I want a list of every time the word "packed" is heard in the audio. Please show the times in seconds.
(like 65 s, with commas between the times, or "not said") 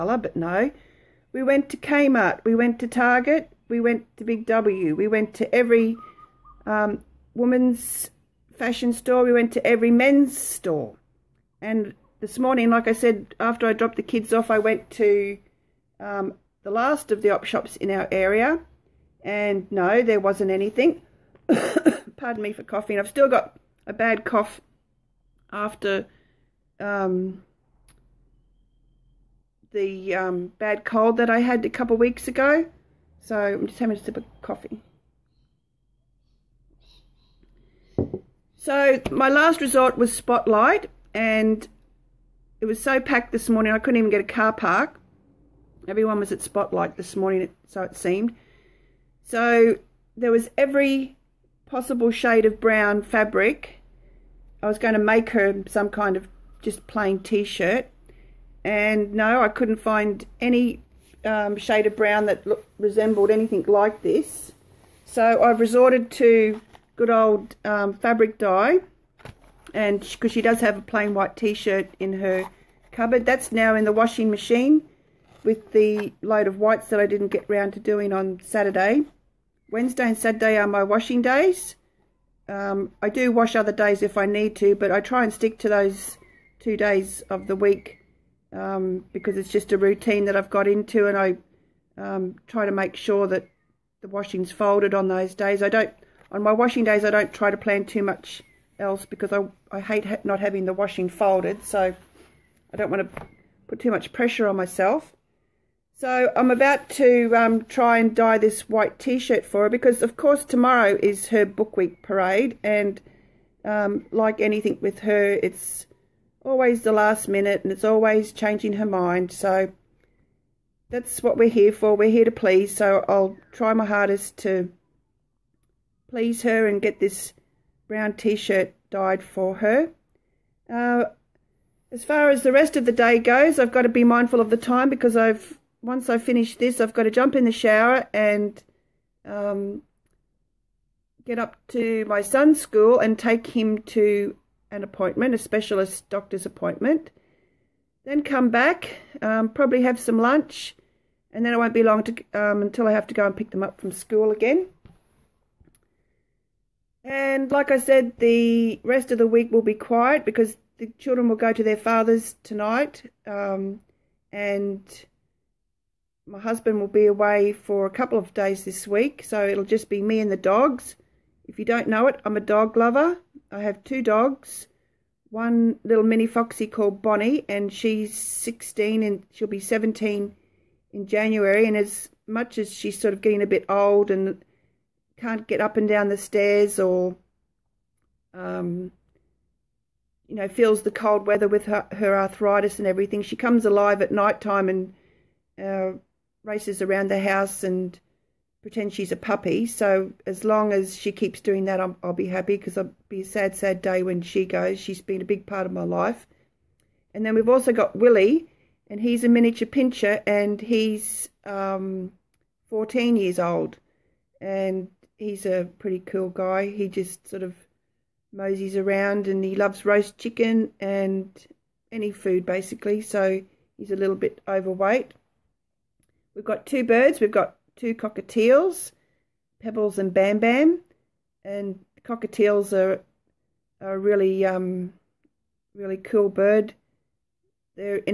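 43 s.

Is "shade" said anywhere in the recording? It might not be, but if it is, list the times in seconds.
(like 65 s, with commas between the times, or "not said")
52 s, 61 s.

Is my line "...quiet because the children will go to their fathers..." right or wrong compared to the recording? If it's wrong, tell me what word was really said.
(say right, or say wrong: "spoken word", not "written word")
right.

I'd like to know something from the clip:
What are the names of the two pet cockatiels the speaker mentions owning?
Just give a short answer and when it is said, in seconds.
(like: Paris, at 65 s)
Pebbles and Bam Bam, at 229 s.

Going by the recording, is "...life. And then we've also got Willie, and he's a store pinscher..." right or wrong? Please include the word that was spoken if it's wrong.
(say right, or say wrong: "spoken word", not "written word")
wrong: "miniature", not "store".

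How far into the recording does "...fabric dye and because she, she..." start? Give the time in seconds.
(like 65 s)
67 s.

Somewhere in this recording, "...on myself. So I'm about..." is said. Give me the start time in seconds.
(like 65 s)
104 s.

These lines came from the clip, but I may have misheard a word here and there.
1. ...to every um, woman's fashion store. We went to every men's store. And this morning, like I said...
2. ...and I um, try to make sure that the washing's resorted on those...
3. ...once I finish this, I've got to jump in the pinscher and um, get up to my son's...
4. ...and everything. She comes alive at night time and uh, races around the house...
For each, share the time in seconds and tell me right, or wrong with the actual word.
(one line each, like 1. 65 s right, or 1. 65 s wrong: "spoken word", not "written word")
1. 5 s right
2. 91 s wrong: "folded", not "resorted"
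3. 135 s wrong: "shower", not "pinscher"
4. 192 s right.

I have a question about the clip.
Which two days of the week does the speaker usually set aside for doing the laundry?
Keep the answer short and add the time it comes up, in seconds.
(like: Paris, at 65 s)
Wednesday and Saturday, at 79 s.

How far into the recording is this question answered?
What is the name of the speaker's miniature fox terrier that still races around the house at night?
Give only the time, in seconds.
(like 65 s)
177 s.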